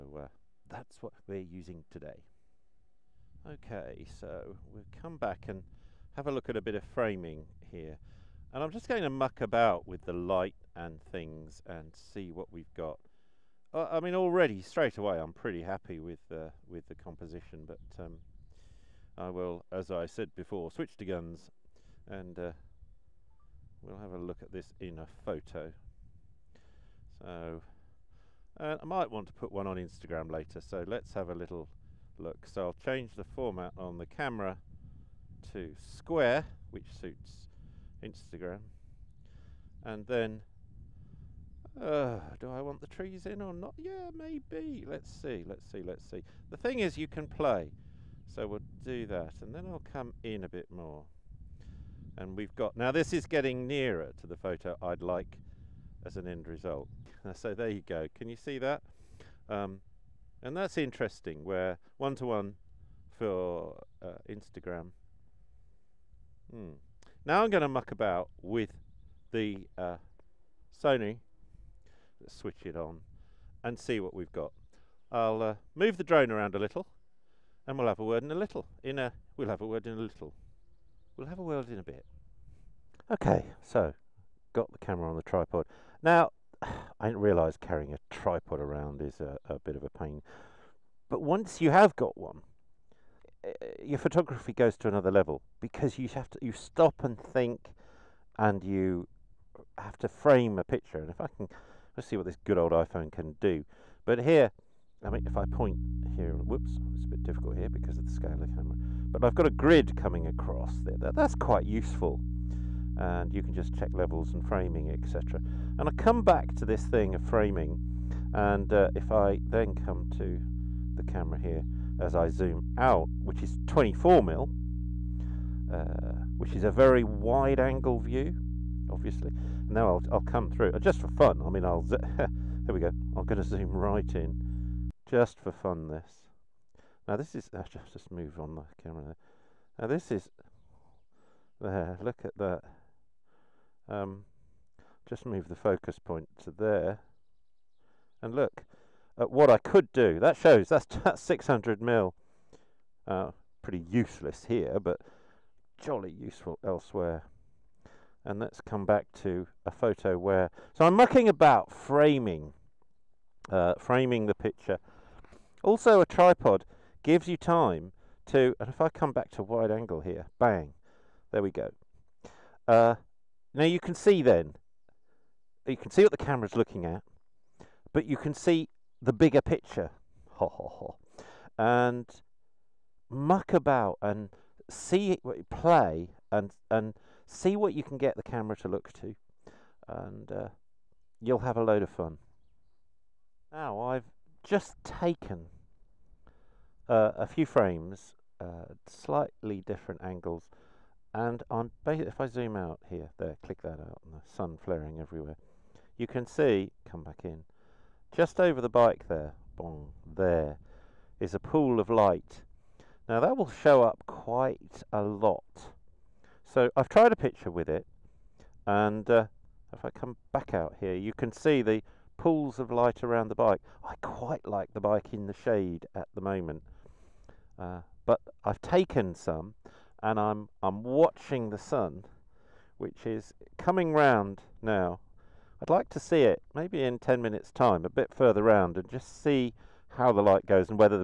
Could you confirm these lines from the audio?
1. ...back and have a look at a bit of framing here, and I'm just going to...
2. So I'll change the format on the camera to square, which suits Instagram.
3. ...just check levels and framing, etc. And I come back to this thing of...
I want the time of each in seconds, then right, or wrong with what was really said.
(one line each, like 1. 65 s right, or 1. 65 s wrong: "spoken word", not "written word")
1. 5 s right
2. 32 s right
3. 113 s right.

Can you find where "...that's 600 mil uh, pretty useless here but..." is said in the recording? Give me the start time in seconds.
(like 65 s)
151 s.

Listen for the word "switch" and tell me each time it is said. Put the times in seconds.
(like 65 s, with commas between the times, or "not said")
20 s, 72 s.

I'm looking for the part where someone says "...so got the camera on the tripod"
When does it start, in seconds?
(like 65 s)
83 s.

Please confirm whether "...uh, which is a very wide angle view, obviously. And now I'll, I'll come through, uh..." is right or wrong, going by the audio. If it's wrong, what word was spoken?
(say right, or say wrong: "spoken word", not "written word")
right.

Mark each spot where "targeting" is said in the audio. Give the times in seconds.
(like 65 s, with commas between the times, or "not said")
not said.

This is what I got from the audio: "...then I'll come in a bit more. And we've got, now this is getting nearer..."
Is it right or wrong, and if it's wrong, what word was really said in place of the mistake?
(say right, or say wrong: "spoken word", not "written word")
right.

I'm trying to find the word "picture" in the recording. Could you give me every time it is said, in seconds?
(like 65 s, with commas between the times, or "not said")
100 s, 164 s, 179 s, 217 s.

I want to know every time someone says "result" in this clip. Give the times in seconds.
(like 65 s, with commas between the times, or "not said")
56 s.